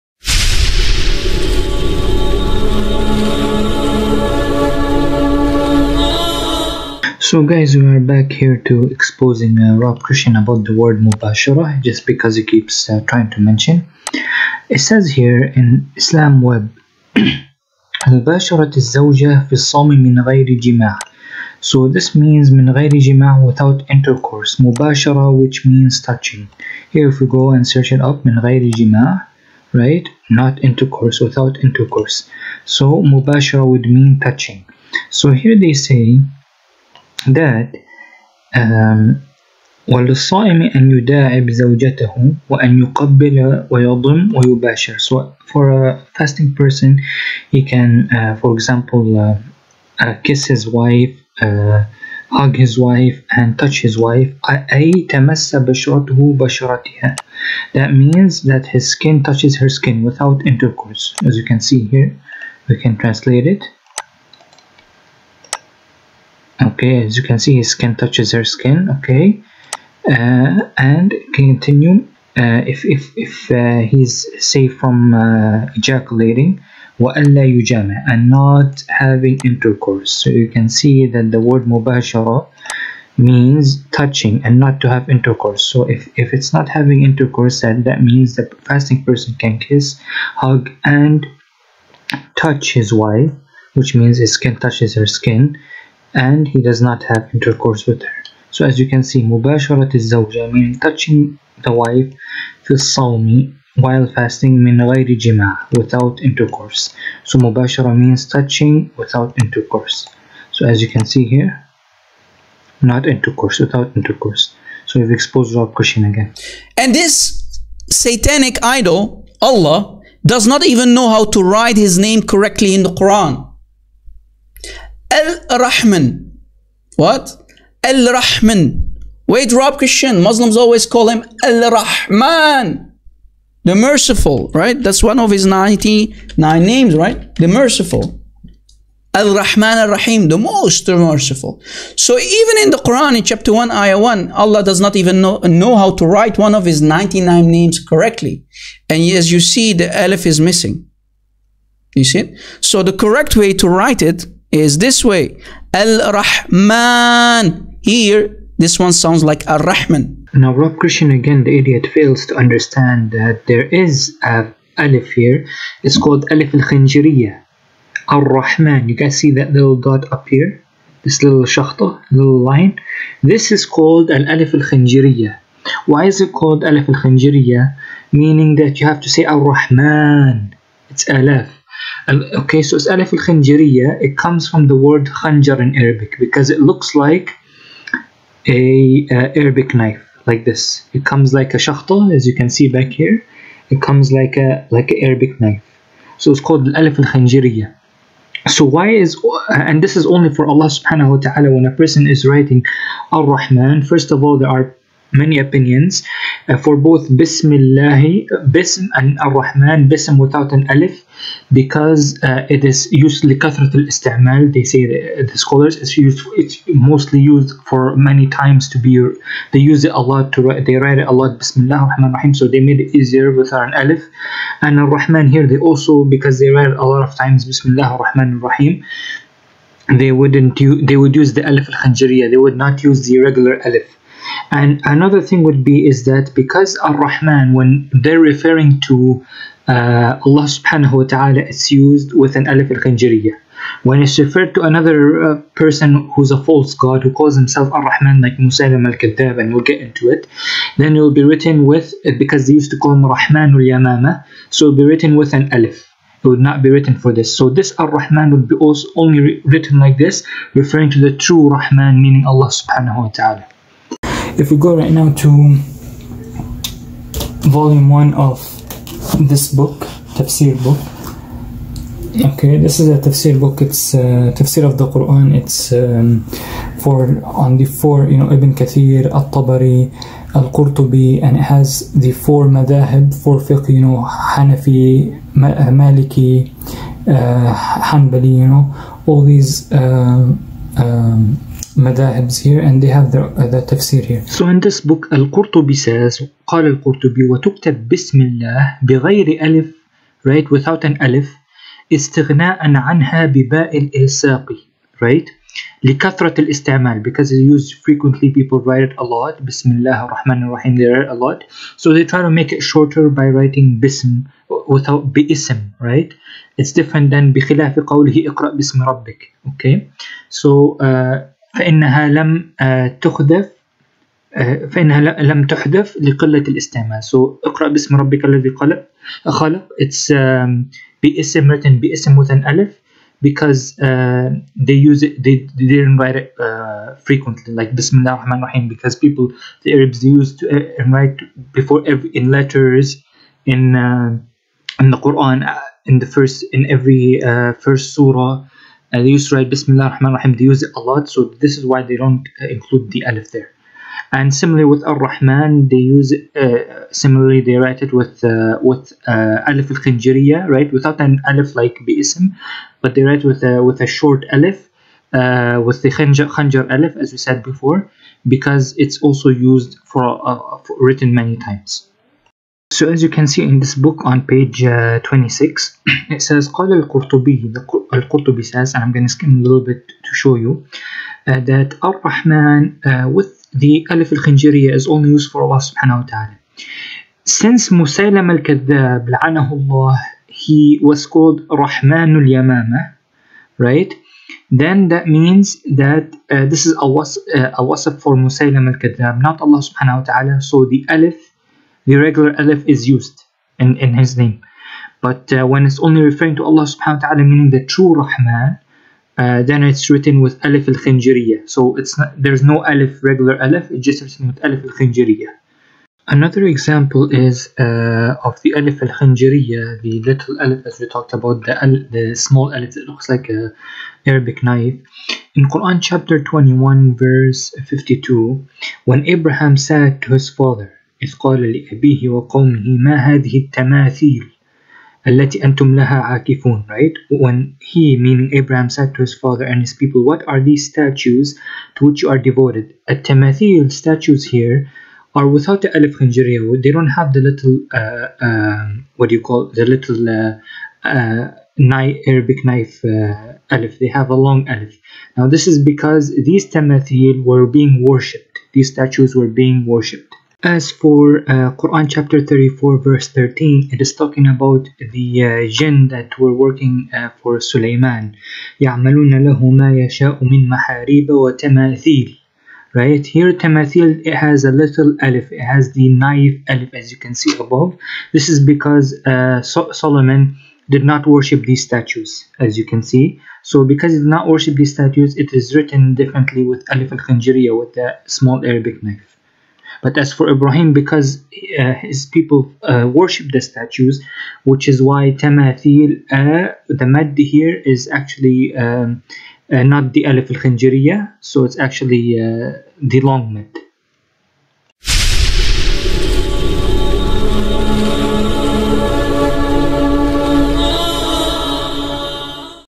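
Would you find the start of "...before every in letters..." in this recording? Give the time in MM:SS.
05:41.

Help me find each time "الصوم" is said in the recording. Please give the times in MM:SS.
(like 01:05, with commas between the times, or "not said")
00:19, 01:42.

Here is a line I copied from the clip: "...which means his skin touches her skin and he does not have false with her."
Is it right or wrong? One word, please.
wrong.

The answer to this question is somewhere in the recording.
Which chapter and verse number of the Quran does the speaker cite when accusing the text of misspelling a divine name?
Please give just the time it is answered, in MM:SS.
02:23.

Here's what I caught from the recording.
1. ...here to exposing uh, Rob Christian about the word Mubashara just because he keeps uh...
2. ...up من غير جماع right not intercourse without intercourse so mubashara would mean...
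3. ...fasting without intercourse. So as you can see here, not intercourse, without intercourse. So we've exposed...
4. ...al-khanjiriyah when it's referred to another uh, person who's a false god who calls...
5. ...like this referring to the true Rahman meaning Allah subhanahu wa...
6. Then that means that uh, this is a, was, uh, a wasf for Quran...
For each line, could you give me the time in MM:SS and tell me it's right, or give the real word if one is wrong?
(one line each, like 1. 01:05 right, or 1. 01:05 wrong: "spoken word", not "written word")
1. 00:08 right
2. 00:28 right
3. 01:48 wrong: "touching", not "fasting"
4. 04:02 right
5. 04:19 right
6. 06:34 wrong: "Musaylam", not "Quran".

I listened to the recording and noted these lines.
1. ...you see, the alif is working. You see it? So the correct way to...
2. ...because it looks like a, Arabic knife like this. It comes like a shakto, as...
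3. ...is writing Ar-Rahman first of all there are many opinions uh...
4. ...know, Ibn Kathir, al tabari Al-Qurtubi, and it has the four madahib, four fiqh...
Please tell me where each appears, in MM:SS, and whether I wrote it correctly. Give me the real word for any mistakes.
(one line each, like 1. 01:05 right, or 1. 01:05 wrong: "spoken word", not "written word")
1. 02:29 wrong: "missing", not "working"
2. 03:06 right
3. 03:22 right
4. 04:38 right.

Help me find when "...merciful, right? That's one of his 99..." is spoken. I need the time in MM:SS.
02:13.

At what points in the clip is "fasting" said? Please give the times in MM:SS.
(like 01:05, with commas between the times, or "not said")
00:46, 01:28, 01:44.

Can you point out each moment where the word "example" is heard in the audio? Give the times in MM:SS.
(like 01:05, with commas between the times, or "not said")
00:48, 06:56.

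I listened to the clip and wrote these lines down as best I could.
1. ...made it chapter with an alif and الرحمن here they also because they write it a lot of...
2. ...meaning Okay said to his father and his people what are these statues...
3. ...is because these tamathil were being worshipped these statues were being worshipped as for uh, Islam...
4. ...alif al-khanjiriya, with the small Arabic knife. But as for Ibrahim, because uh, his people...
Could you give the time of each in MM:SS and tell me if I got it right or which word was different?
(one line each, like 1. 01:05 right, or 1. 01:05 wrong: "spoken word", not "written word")
1. 03:42 wrong: "easier", not "chapter"
2. 07:17 wrong: "Abraham", not "Okay"
3. 07:35 wrong: "Quran", not "Islam"
4. 08:06 right.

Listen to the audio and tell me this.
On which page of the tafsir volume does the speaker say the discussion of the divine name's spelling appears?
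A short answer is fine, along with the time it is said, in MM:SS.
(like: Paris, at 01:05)
26, at 06:15.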